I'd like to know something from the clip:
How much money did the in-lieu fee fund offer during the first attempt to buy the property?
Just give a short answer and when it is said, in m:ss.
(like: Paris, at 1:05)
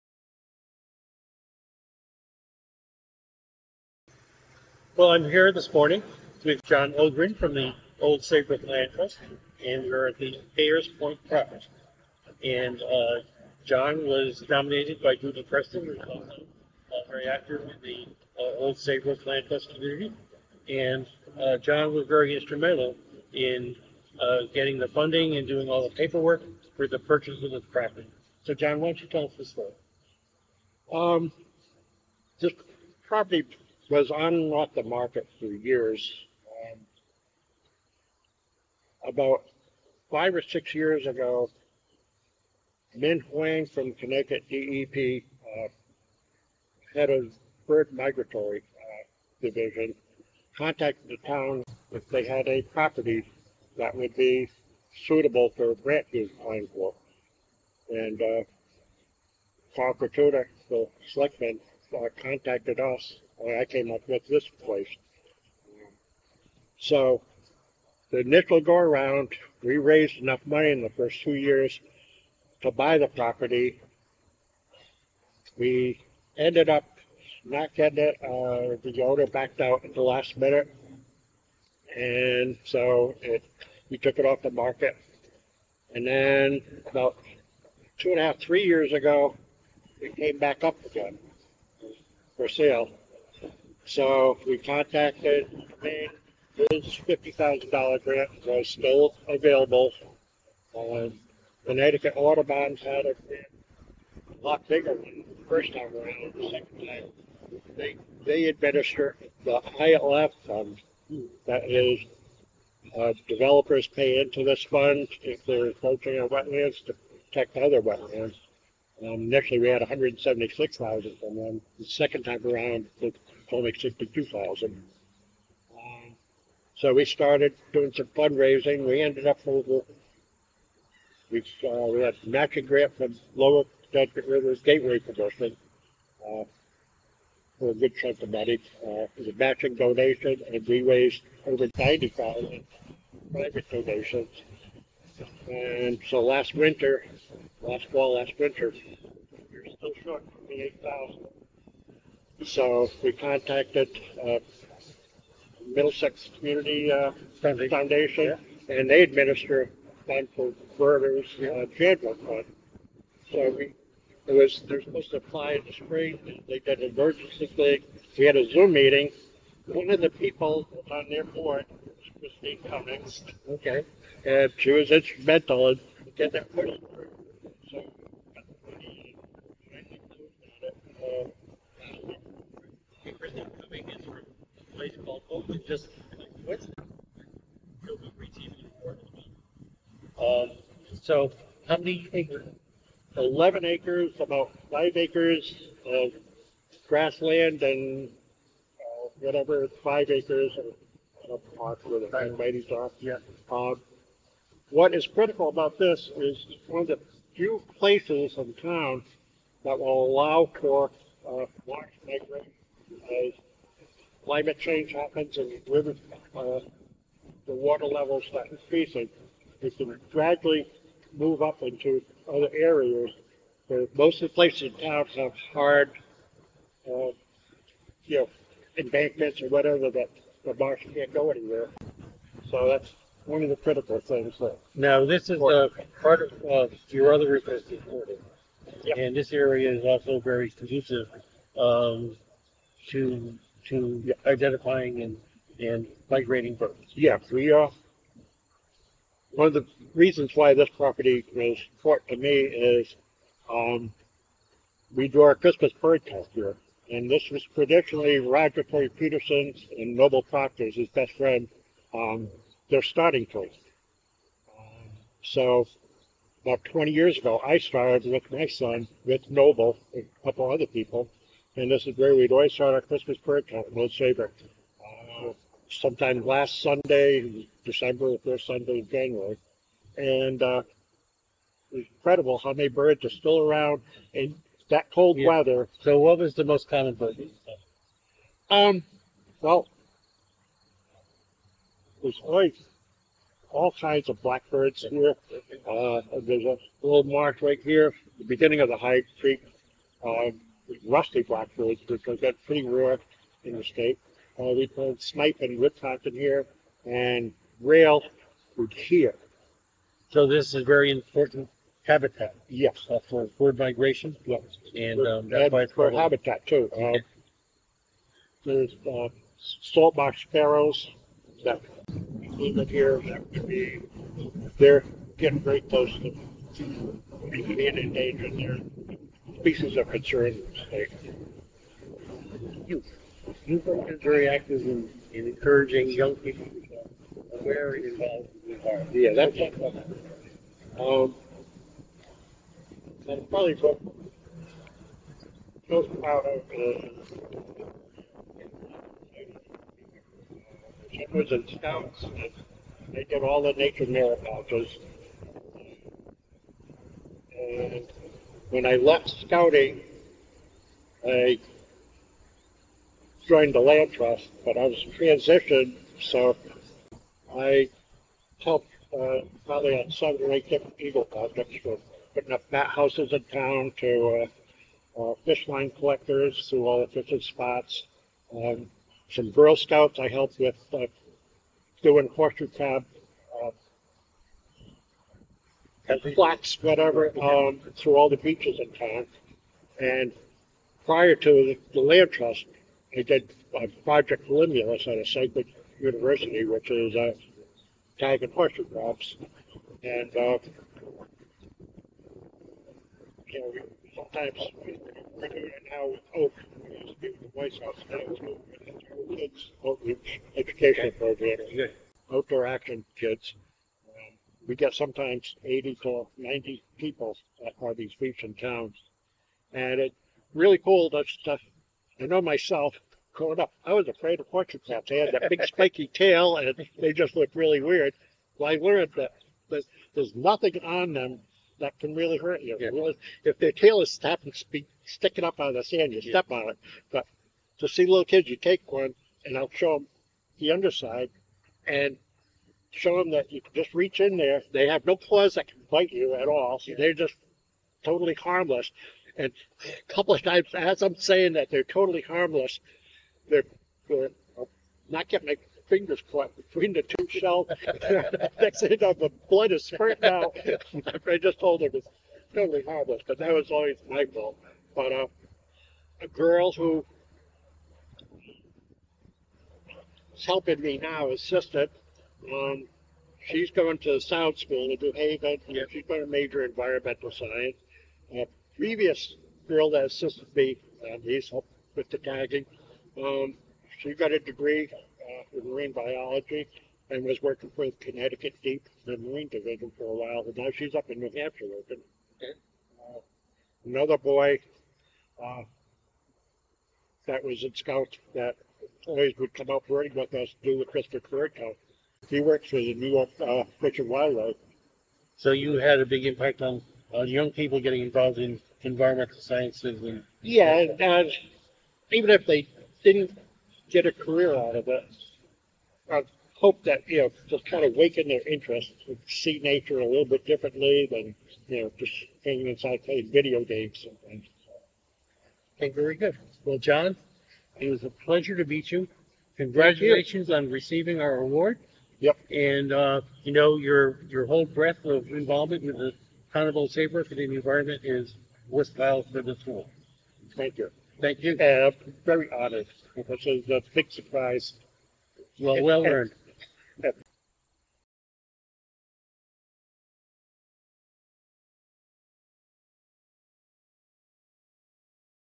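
176,000, at 1:59.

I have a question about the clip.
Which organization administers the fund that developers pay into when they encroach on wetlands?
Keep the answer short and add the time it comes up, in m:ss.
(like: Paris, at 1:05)
Connecticut Audubon, at 1:41.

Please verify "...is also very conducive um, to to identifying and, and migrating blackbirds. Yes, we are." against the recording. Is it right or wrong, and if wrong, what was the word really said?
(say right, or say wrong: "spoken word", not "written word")
wrong: "birds", not "blackbirds".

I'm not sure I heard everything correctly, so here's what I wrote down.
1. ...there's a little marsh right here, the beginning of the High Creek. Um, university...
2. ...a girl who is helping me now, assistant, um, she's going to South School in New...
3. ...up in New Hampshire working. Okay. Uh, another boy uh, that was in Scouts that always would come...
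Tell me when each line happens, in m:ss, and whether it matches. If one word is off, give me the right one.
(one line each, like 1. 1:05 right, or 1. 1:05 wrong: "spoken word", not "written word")
1. 4:56 wrong: "rusty", not "university"
2. 7:46 right
3. 8:10 right.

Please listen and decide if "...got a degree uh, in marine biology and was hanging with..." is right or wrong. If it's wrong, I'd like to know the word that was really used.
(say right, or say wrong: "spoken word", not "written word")
wrong: "working", not "hanging".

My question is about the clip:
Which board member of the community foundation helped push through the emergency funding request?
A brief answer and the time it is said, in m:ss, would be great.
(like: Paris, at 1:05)
Christine Cummings, at 2:52.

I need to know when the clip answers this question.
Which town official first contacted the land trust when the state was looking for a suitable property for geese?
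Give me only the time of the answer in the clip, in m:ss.
0:59.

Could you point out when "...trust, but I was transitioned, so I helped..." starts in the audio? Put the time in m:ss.
6:03.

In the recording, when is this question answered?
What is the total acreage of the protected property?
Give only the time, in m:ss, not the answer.
3:13.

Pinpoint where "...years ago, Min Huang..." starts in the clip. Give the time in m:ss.
0:40.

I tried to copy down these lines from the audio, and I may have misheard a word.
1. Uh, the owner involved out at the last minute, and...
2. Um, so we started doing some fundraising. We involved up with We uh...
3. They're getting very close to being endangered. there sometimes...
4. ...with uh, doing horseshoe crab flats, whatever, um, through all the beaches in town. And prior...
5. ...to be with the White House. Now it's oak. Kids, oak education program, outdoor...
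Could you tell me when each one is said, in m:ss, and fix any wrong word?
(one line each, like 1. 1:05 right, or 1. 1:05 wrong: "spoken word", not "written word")
1. 1:18 wrong: "backed", not "involved"
2. 2:05 wrong: "ended", not "involved"
3. 5:24 wrong: "species", not "sometimes"
4. 6:20 right
5. 6:46 right.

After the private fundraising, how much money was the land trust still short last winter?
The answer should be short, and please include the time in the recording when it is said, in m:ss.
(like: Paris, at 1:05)
8,000, at 2:30.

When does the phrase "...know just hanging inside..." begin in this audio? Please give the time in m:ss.
8:41.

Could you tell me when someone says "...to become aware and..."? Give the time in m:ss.
5:36.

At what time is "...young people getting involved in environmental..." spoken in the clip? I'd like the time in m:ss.
8:27.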